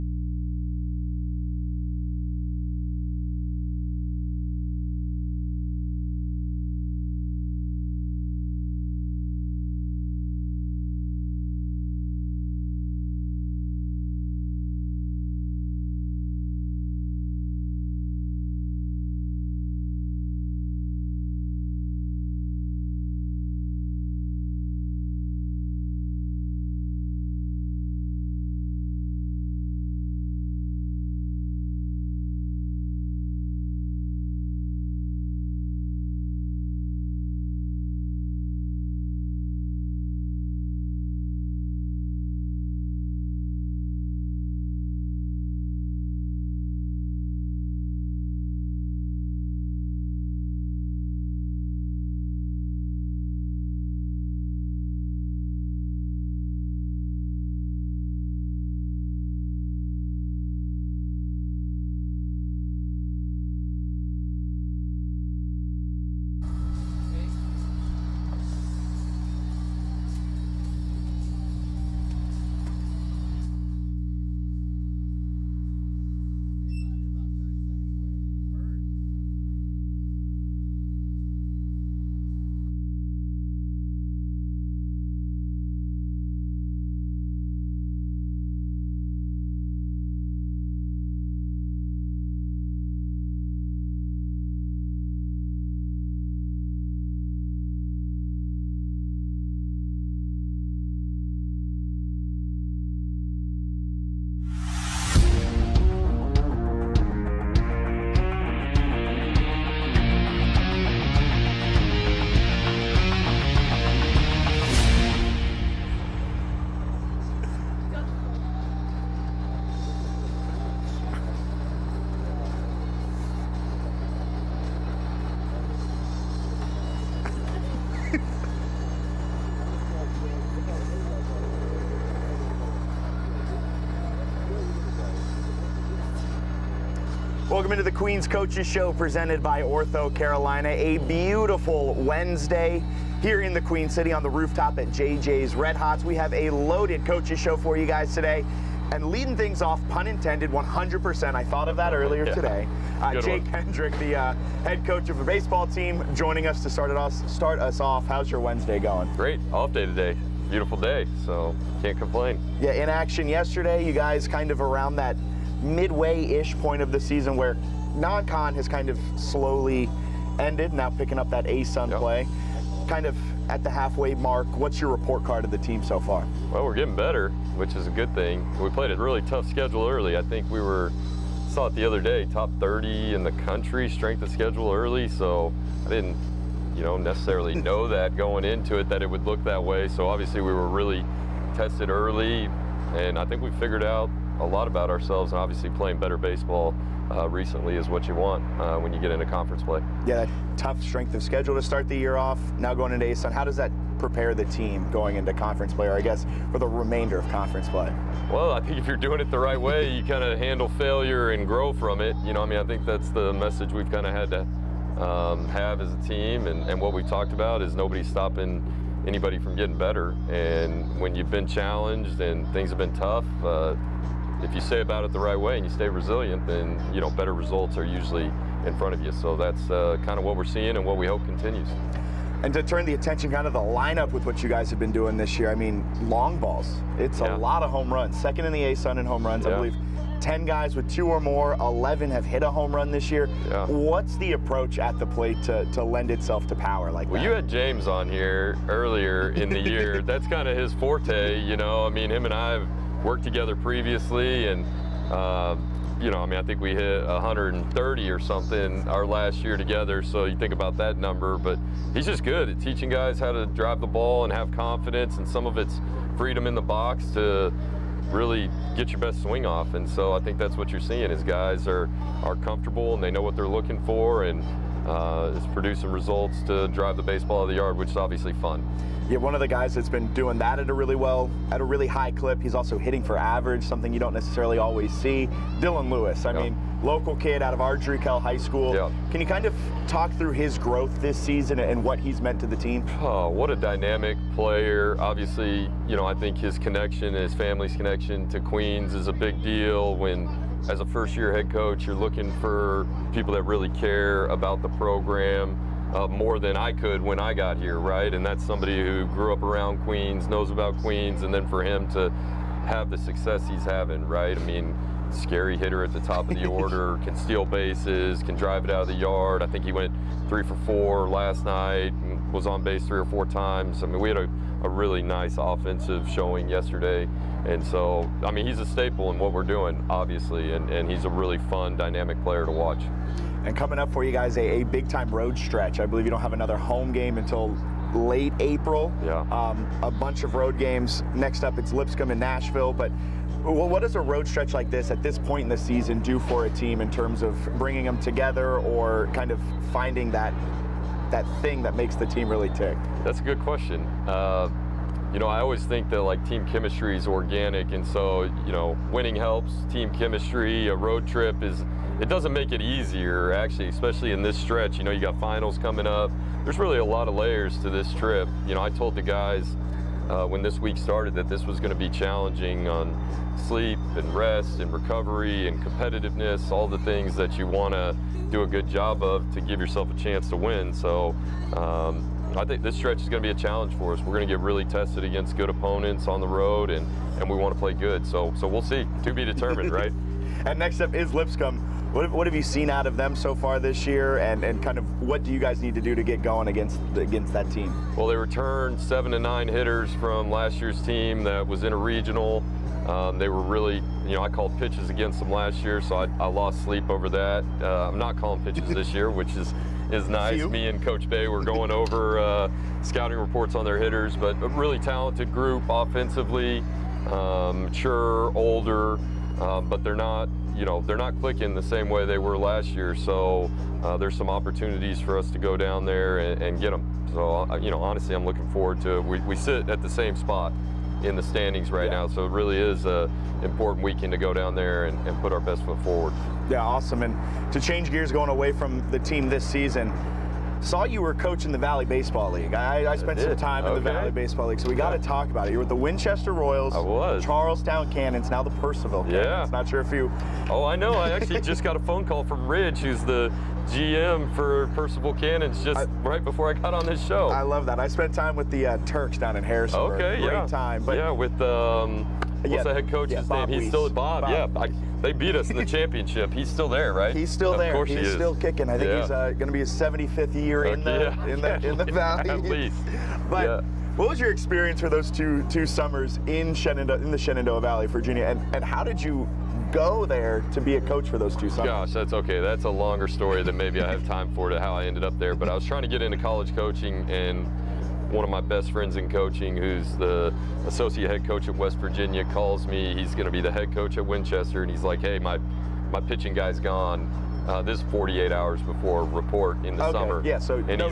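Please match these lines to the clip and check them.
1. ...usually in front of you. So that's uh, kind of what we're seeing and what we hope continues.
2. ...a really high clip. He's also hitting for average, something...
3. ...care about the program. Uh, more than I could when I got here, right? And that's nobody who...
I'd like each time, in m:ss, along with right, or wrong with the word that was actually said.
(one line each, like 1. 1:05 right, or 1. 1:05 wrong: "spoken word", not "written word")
1. 3:47 right
2. 4:41 right
3. 5:03 wrong: "somebody", not "nobody".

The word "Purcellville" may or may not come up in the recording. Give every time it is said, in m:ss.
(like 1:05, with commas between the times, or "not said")
7:28, 7:34.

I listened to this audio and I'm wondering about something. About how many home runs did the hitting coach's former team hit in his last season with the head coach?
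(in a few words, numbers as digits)
130.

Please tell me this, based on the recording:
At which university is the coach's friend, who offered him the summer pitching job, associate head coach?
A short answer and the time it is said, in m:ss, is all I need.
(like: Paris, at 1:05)
West Virginia, at 8:11.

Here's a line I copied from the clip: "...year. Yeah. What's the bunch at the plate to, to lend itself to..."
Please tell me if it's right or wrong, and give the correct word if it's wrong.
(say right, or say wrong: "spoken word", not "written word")
wrong: "approach", not "bunch".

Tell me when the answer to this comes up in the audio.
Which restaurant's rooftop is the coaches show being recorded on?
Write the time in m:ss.
2:24.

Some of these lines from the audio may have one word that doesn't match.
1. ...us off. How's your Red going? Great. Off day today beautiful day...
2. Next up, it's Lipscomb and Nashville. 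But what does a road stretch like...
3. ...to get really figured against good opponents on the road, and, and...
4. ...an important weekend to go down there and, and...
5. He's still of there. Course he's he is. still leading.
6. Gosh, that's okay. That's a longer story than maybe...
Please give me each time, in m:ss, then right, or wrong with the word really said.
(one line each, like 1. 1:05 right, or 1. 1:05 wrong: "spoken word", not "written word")
1. 2:37 wrong: "Wednesday", not "Red"
2. 5:41 right
3. 6:24 wrong: "tested", not "figured"
4. 7:12 right
5. 7:47 wrong: "kicking", not "leading"
6. 8:01 right.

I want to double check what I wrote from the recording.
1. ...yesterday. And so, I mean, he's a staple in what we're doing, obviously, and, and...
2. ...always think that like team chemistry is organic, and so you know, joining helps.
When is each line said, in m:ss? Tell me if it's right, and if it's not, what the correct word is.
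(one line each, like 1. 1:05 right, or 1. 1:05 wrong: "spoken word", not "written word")
1. 5:26 right
2. 5:55 wrong: "winning", not "joining".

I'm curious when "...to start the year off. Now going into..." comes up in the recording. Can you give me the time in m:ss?
3:21.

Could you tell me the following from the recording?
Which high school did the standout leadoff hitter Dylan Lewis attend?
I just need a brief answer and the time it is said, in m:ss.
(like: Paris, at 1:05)
Ardrey Kell High School, at 4:47.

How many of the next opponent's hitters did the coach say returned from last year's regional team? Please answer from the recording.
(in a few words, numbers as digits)
7.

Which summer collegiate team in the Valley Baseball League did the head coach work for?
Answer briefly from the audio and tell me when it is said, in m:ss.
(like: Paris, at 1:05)
Winchester Royals, at 7:25.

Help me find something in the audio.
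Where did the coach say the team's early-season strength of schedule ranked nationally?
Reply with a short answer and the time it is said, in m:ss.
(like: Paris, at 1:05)
top 30, at 3:02.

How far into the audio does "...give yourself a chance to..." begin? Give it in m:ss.
6:19.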